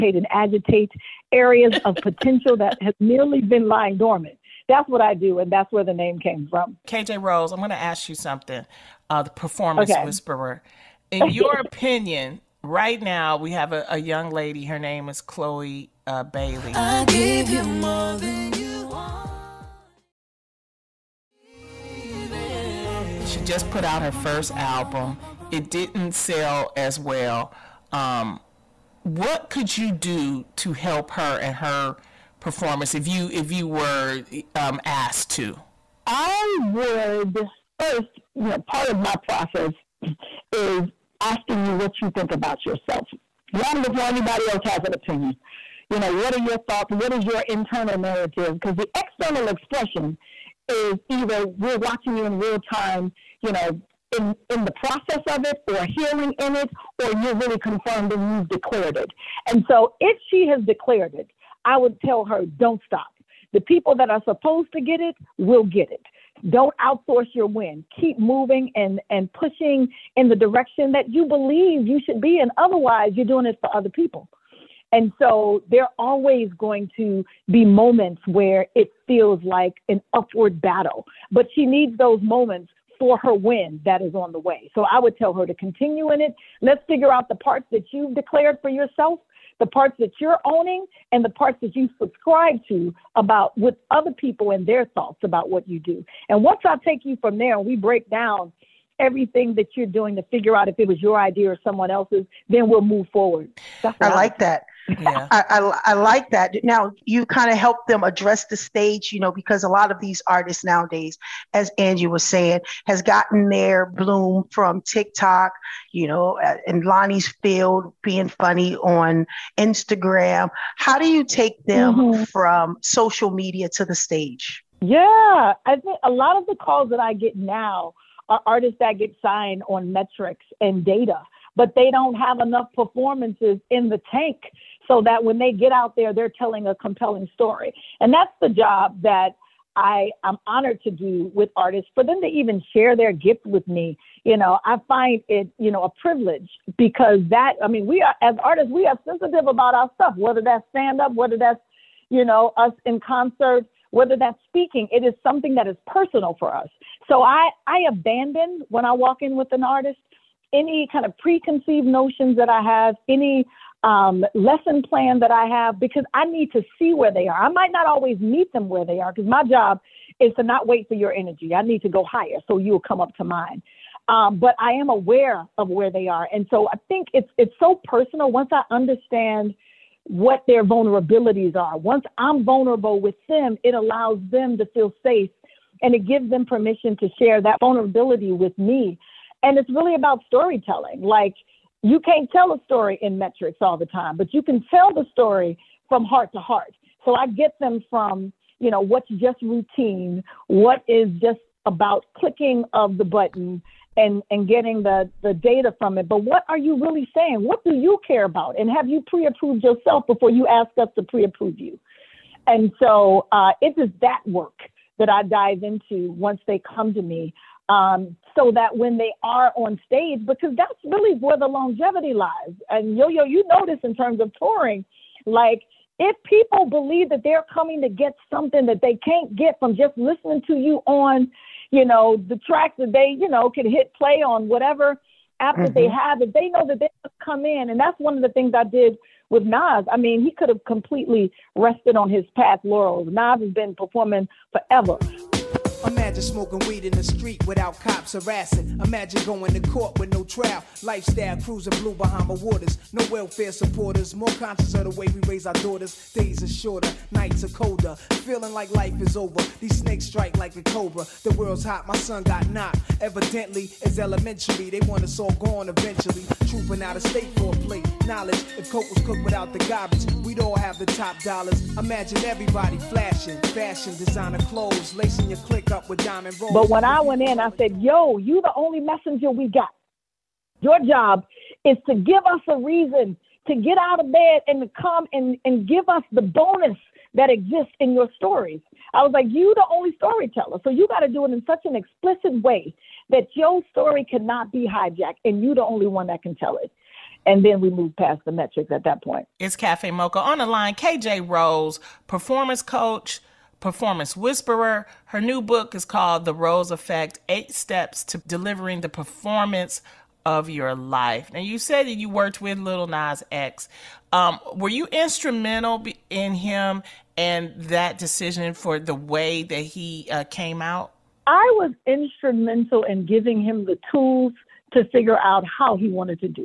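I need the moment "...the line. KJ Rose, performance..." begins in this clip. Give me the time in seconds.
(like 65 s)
300 s.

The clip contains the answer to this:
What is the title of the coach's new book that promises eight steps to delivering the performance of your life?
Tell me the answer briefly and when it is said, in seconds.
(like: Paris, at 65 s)
The Rose Effect, at 306 s.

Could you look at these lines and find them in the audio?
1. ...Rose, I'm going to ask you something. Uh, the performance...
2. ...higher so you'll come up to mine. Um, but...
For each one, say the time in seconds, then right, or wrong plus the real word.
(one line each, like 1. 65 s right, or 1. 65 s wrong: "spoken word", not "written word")
1. 7 s right
2. 172 s right.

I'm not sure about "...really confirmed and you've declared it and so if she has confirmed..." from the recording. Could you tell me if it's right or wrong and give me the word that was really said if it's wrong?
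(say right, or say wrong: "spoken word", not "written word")
wrong: "declared", not "confirmed".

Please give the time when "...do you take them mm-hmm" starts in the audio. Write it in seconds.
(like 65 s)
120 s.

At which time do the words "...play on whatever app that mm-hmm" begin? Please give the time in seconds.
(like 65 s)
233 s.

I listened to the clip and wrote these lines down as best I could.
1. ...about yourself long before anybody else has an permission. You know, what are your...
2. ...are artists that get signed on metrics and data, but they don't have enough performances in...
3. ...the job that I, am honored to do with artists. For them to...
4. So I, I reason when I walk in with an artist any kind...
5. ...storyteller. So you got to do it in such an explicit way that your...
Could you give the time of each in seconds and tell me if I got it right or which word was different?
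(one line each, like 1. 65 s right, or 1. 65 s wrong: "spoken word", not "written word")
1. 42 s wrong: "opinion", not "permission"
2. 128 s right
3. 138 s right
4. 157 s wrong: "abandon", not "reason"
5. 289 s right.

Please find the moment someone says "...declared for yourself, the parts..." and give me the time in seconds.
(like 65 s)
88 s.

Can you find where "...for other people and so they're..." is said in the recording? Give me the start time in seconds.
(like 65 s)
73 s.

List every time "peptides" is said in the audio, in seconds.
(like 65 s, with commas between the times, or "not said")
not said.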